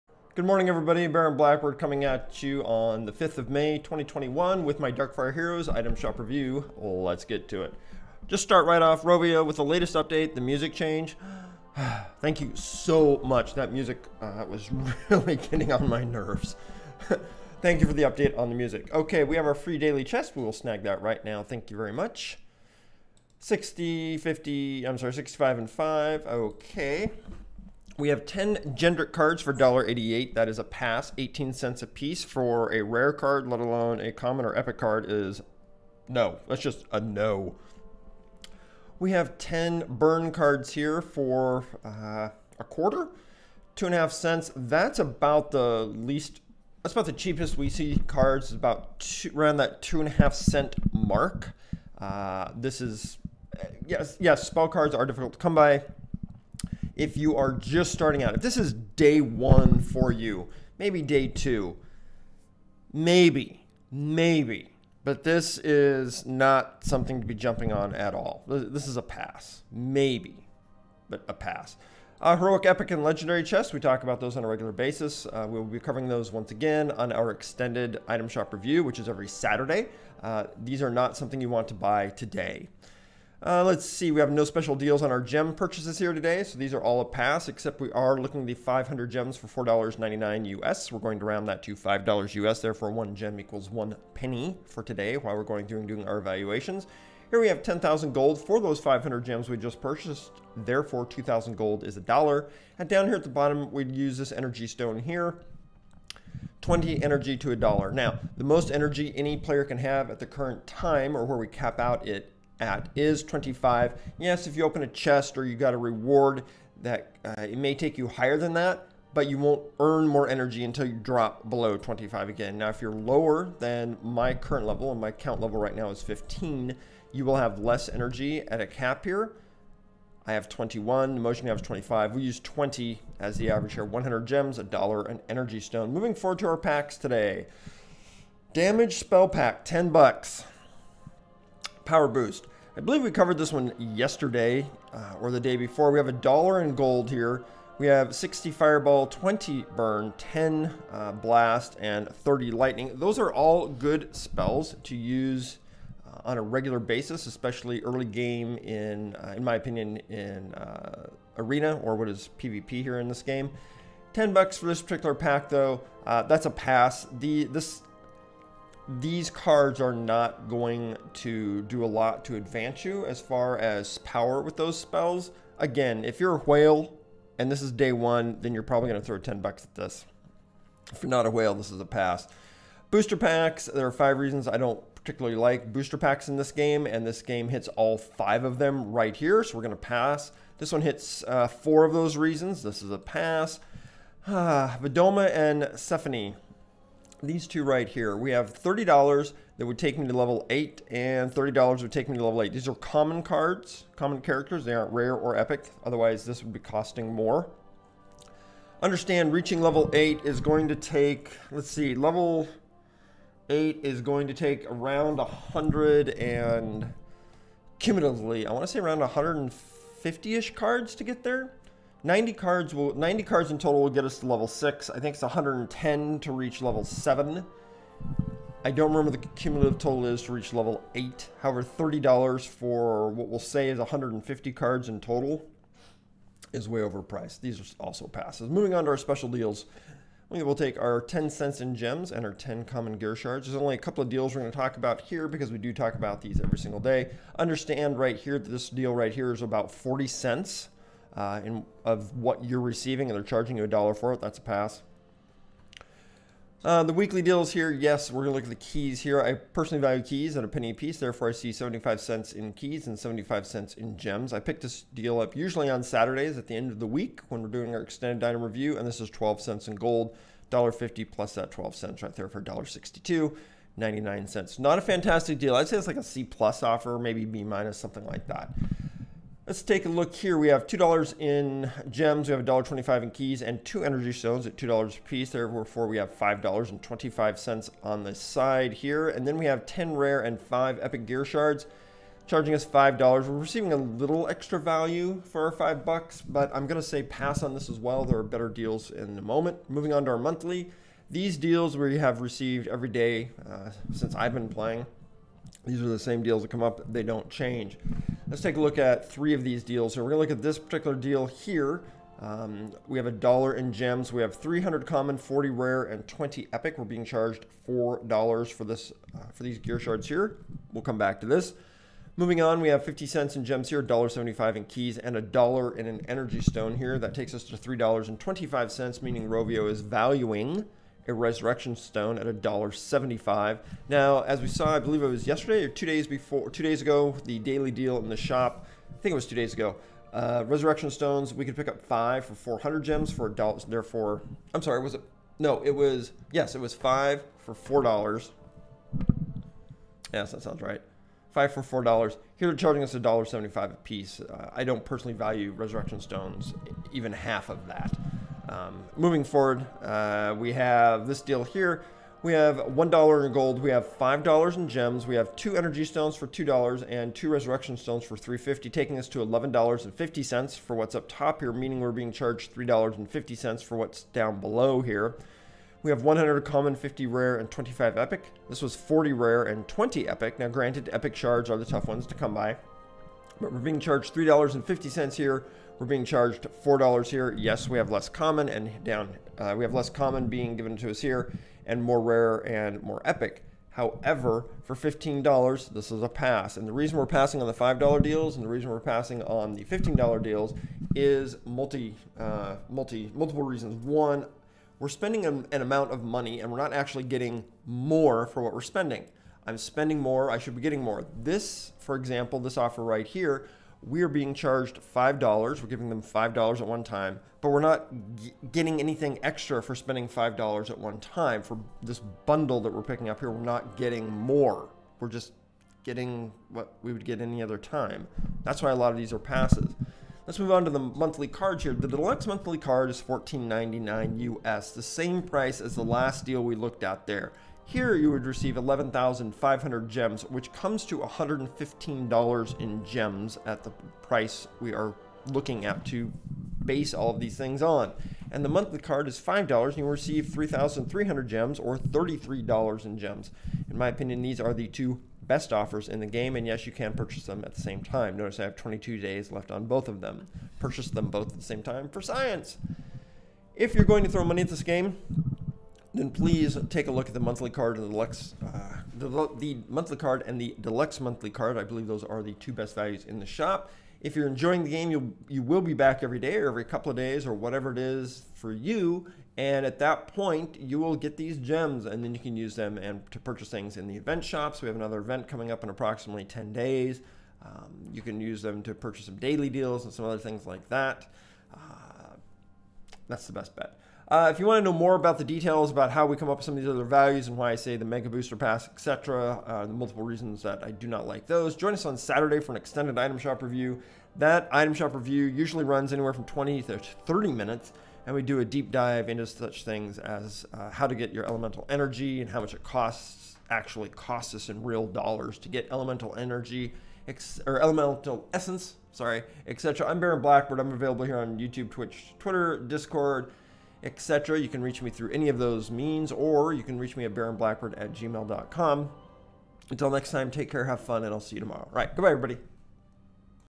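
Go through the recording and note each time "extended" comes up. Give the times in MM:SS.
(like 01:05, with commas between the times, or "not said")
01:17, 04:27, 08:22.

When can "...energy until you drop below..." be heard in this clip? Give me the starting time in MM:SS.
02:00.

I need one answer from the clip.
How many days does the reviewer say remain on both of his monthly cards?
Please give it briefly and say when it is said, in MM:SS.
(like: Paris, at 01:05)
22, at 07:38.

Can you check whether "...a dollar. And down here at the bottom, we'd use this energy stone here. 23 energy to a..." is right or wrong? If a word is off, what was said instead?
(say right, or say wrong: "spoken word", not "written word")
wrong: "20", not "23".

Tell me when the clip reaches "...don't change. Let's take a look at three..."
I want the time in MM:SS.
05:07.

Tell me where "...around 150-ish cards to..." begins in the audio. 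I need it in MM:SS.
03:38.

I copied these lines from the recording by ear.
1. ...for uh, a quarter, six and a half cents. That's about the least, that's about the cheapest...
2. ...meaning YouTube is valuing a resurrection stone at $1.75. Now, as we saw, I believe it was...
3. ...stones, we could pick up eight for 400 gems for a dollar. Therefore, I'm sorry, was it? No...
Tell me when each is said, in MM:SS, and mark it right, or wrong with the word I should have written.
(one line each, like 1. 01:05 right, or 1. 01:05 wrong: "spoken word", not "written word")
1. 00:41 wrong: "two", not "six"
2. 05:29 wrong: "Rovio", not "YouTube"
3. 05:40 wrong: "five", not "eight".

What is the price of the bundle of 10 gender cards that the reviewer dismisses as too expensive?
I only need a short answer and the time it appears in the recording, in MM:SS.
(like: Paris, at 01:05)
$1.88, at 00:29.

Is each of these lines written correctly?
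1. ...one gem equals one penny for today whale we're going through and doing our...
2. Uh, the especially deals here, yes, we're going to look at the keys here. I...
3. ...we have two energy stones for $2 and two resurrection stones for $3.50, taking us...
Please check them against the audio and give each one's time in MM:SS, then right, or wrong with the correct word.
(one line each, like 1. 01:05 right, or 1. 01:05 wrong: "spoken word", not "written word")
1. 01:32 wrong: "while", not "whale"
2. 04:16 wrong: "weekly", not "especially"
3. 06:05 right.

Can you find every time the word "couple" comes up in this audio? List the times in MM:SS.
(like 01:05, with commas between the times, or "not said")
04:03, 07:56.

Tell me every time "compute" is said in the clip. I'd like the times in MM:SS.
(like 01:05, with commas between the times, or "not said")
not said.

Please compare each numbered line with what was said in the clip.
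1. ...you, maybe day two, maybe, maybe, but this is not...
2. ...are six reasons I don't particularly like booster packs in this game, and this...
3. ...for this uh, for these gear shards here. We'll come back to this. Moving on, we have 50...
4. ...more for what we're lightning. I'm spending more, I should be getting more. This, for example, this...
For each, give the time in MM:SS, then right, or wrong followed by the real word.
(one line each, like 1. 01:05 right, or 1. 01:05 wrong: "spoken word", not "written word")
1. 01:00 right
2. 03:03 wrong: "five", not "six"
3. 05:18 right
4. 06:47 wrong: "spending", not "lightning".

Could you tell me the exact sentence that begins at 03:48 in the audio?
I don't remember the cumulative total is to reach level 8.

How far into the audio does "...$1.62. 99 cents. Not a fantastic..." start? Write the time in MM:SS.
04:32.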